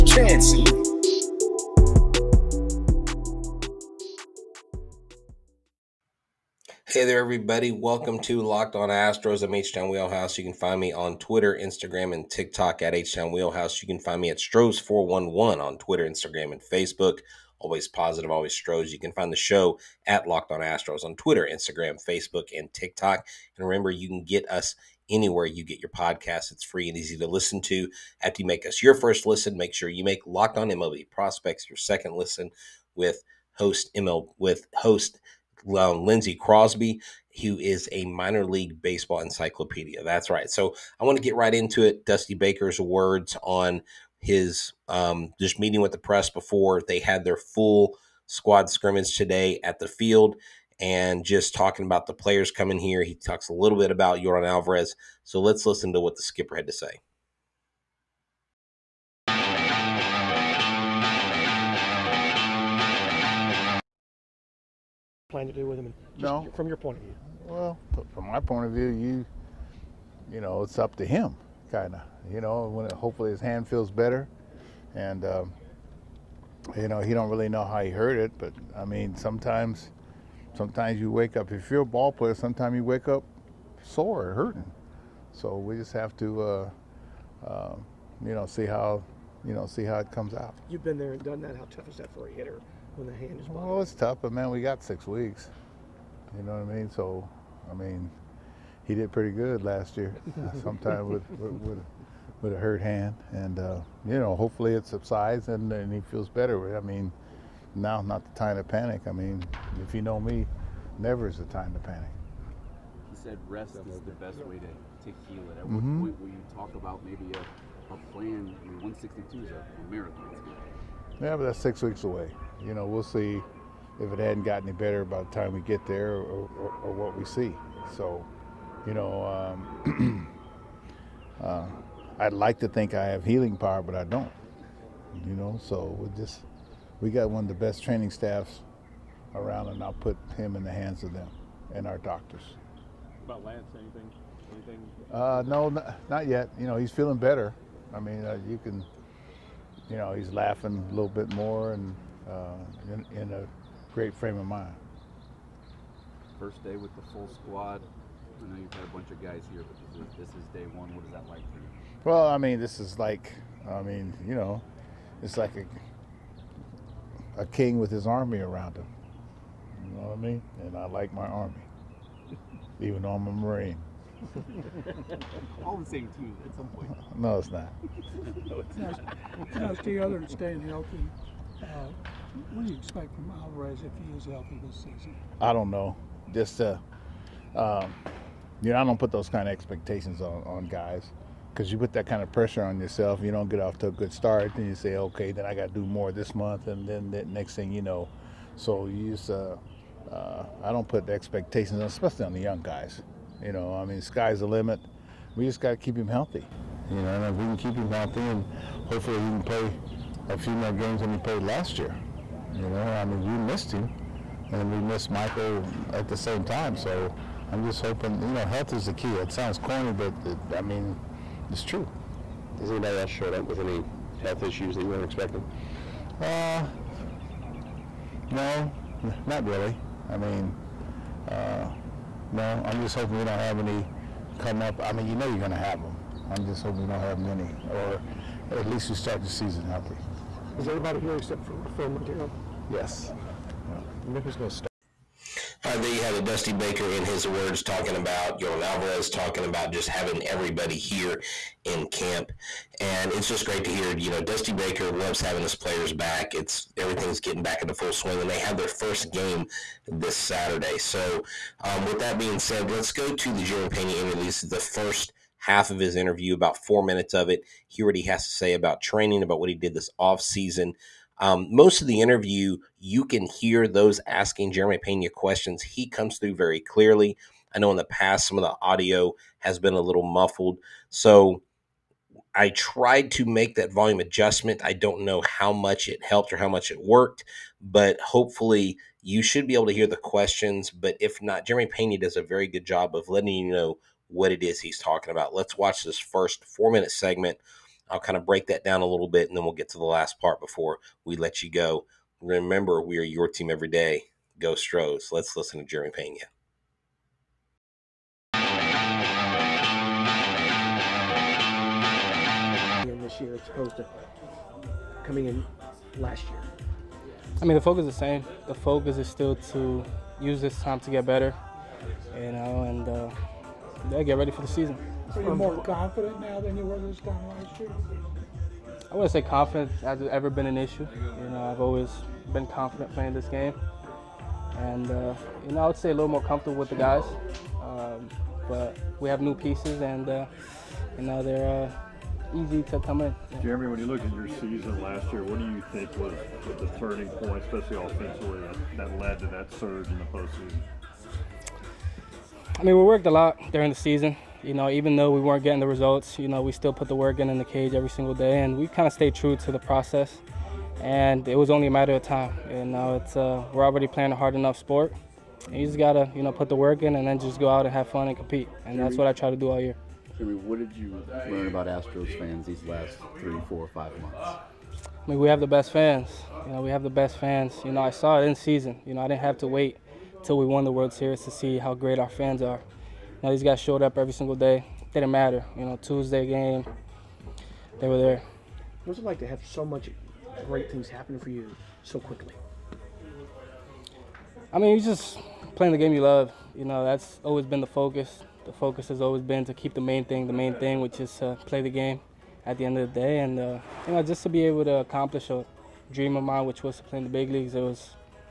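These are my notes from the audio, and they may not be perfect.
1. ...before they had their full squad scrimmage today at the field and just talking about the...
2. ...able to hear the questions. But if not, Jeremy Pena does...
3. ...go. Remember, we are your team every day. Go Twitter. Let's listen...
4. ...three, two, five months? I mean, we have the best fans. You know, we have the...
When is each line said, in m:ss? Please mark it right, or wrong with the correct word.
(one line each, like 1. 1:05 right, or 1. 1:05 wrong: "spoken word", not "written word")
1. 0:46 right
2. 4:49 right
3. 5:01 wrong: "Stros", not "Twitter"
4. 6:13 wrong: "four", not "two".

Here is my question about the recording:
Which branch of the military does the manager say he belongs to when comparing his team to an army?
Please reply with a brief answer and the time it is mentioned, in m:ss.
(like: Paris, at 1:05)
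Marine, at 2:53.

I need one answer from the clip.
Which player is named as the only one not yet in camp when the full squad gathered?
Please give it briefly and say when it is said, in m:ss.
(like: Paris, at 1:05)
Phil Montero, at 4:01.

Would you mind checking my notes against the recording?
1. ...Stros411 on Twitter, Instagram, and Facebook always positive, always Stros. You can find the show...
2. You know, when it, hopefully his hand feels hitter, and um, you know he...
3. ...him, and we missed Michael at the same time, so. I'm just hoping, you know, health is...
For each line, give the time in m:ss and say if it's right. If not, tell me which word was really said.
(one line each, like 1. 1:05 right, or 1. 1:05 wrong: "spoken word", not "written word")
1. 0:14 right
2. 1:12 wrong: "better", not "hitter"
3. 3:33 right.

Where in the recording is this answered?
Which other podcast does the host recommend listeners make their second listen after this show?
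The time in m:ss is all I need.
0:30.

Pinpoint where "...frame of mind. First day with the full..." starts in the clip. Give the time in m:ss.
2:34.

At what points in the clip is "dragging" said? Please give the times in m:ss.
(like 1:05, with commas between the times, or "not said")
not said.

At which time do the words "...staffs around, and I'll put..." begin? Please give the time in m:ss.
2:18.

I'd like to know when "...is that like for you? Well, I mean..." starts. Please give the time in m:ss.
2:41.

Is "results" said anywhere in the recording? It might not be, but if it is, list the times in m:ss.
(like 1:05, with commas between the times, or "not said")
5:55.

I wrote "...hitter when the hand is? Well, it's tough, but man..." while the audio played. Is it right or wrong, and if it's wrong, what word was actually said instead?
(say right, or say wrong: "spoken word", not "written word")
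right.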